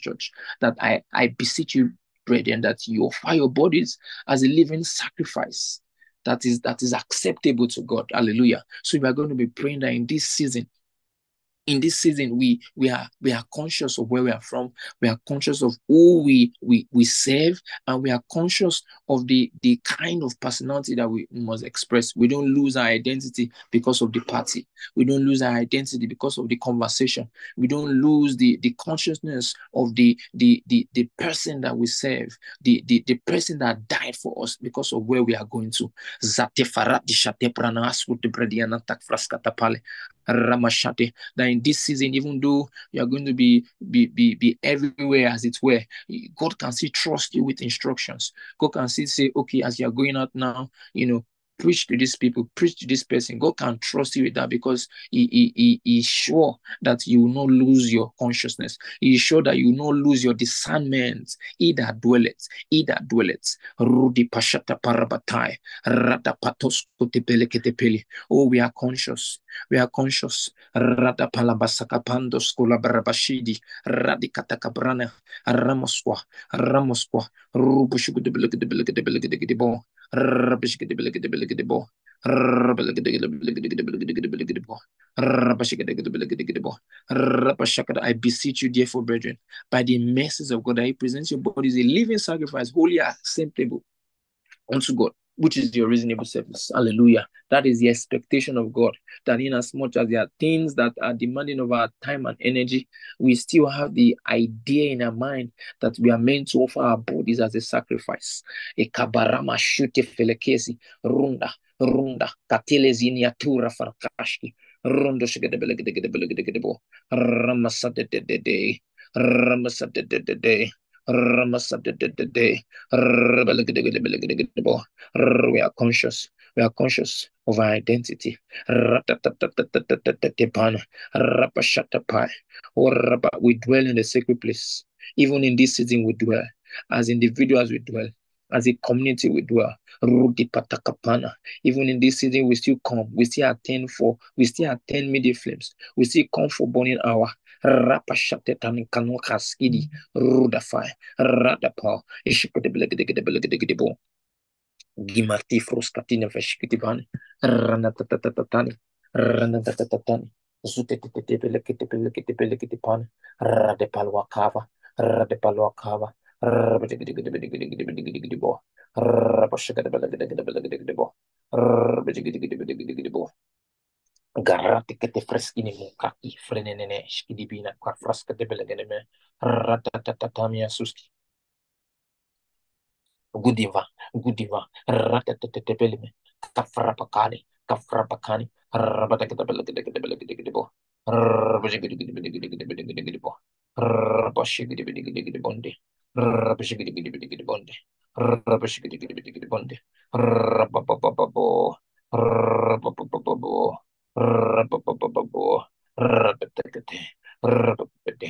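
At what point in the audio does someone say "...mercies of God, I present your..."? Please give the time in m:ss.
1:29.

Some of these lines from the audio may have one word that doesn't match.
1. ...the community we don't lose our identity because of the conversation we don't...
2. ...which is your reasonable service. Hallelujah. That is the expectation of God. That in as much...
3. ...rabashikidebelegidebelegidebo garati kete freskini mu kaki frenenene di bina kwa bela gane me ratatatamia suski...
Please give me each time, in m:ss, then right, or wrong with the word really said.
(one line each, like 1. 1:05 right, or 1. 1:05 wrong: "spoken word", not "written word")
1. 0:24 wrong: "party", not "community"
2. 1:35 right
3. 2:49 right.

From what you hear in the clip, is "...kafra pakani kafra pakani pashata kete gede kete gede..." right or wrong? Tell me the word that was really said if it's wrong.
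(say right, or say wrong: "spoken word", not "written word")
wrong: "rabata", not "pashata".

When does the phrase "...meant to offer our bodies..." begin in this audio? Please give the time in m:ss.
1:46.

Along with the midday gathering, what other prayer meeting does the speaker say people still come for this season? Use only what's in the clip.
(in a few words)
Burning Hour.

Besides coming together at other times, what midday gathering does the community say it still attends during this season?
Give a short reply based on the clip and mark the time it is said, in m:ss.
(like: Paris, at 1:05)
Midday Flames, at 2:25.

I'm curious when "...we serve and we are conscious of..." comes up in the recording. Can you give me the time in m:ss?
0:16.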